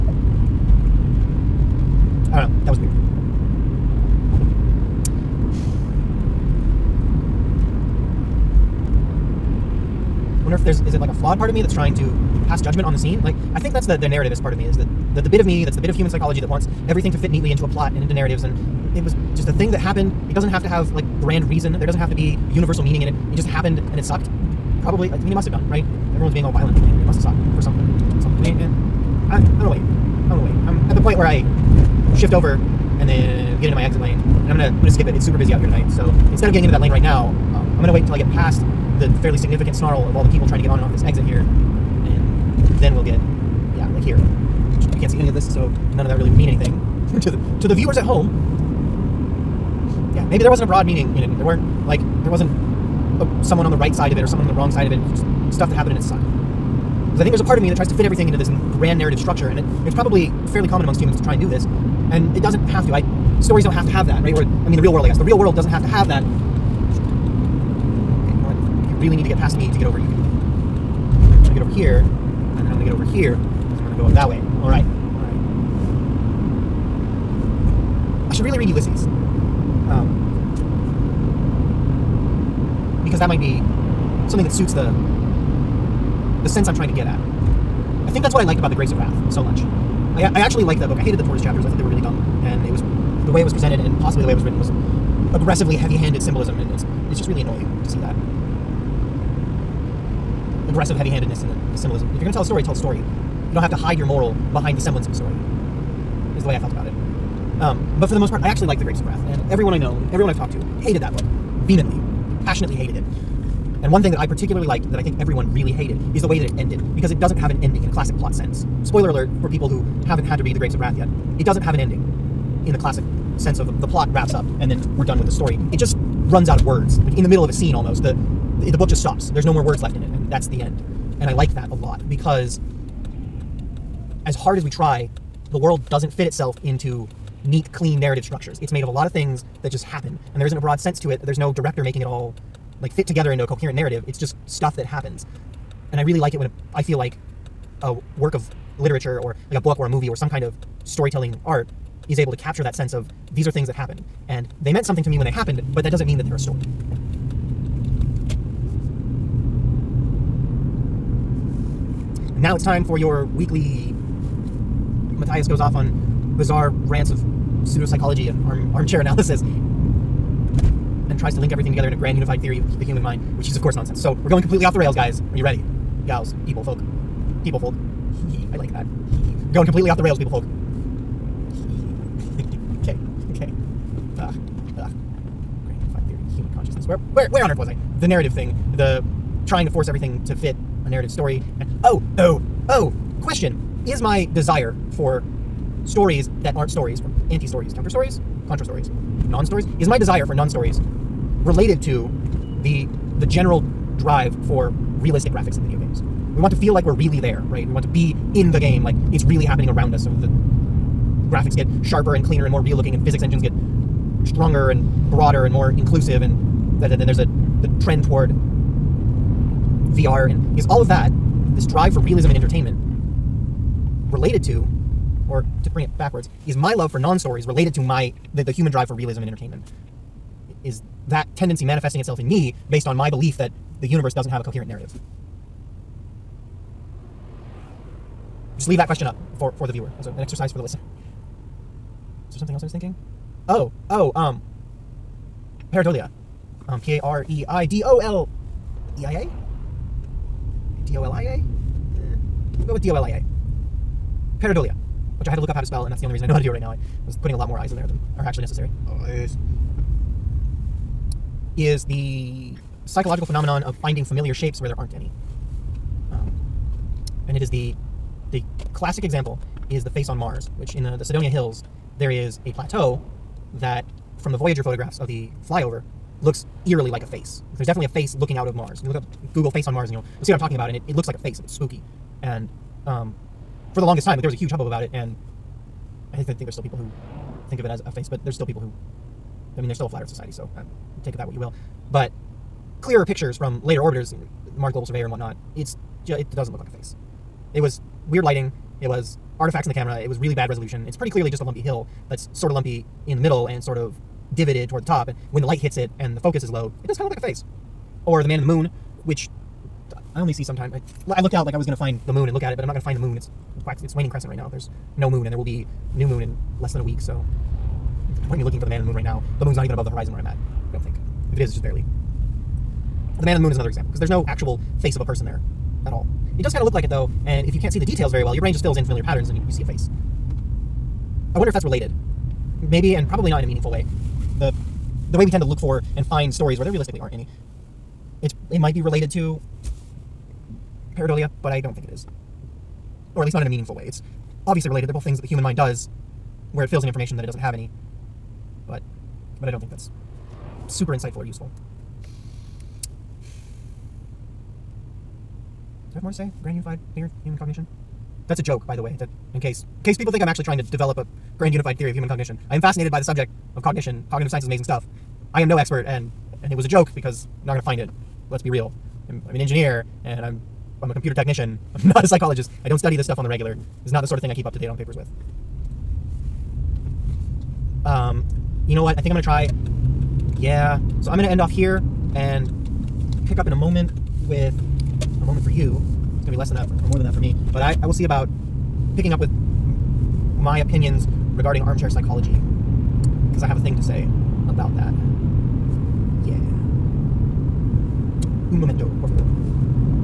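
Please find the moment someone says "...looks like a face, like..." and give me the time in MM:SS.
04:40.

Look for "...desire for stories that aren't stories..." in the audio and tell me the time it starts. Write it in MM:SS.
03:14.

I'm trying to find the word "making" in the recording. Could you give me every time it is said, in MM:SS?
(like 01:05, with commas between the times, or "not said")
02:21.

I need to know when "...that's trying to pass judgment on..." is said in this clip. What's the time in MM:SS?
00:11.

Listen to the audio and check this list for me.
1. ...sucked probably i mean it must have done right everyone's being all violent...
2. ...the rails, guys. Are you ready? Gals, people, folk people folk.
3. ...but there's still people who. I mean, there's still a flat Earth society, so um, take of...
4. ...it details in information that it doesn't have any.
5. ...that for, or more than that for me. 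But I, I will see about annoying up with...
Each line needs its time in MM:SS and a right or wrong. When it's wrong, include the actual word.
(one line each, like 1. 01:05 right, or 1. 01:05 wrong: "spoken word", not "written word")
1. 00:24 right
2. 02:54 right
3. 04:48 right
4. 05:46 wrong: "fills", not "details"
5. 06:26 wrong: "picking", not "annoying".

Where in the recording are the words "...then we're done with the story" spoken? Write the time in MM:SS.
02:04.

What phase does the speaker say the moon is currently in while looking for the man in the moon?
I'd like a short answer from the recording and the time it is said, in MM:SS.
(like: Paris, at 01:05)
waning crescent, at 05:13.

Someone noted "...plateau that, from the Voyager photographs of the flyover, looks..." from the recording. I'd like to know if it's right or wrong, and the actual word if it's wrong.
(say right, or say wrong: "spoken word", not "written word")
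right.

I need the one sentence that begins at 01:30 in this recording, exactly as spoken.
I, I actually liked that book.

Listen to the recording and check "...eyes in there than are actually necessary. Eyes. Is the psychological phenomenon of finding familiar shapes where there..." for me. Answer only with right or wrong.
right.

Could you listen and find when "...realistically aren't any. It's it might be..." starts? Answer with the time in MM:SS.
05:36.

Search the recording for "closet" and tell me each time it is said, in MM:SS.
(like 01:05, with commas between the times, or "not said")
not said.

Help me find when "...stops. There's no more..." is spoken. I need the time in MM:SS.
02:09.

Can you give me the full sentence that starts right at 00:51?
There weren't like there wasn't someone on the right side of it or someone on the wrong side of it.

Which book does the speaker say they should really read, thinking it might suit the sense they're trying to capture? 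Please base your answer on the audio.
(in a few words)
Ulysses.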